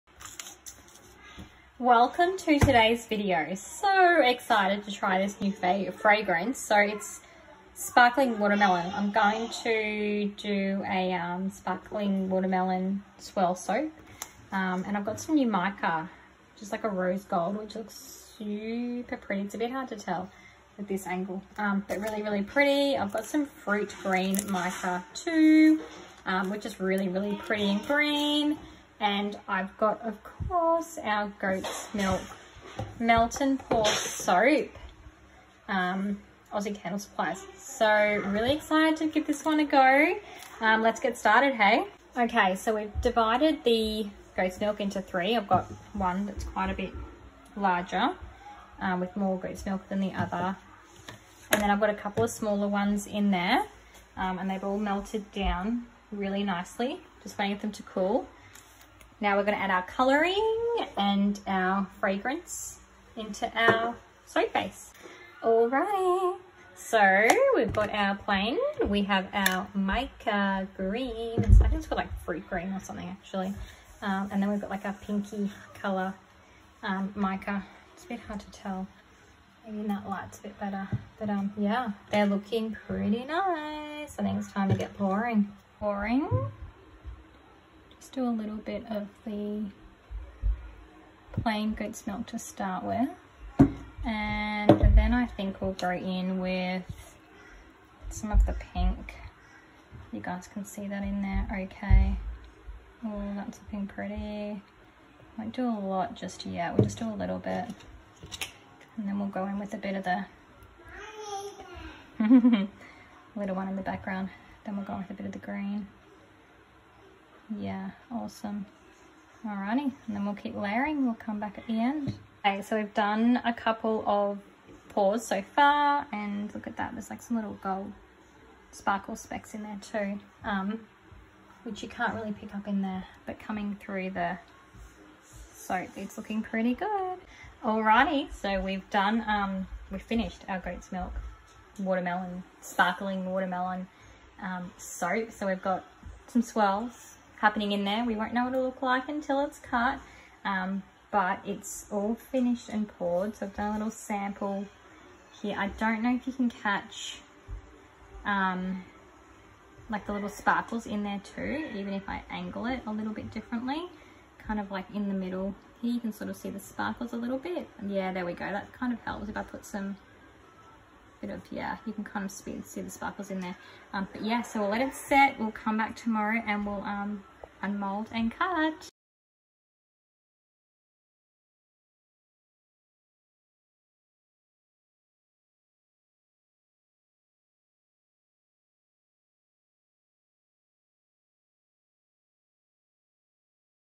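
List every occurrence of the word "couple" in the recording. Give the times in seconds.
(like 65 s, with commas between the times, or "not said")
51 s, 123 s.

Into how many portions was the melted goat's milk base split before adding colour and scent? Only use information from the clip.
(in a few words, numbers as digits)
3.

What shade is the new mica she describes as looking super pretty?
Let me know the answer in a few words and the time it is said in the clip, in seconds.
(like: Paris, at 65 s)
Rose gold, at 16 s.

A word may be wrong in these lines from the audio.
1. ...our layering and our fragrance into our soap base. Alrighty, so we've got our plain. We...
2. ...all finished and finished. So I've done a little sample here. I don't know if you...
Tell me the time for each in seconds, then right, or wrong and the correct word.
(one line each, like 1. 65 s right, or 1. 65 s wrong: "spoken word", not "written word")
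1. 59 s wrong: "coloring", not "layering"
2. 151 s wrong: "poured", not "finished".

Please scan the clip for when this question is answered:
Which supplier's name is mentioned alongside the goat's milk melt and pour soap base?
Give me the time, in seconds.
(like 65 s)
36 s.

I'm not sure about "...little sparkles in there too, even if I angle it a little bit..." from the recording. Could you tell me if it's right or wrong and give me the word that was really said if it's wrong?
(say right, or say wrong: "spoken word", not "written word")
right.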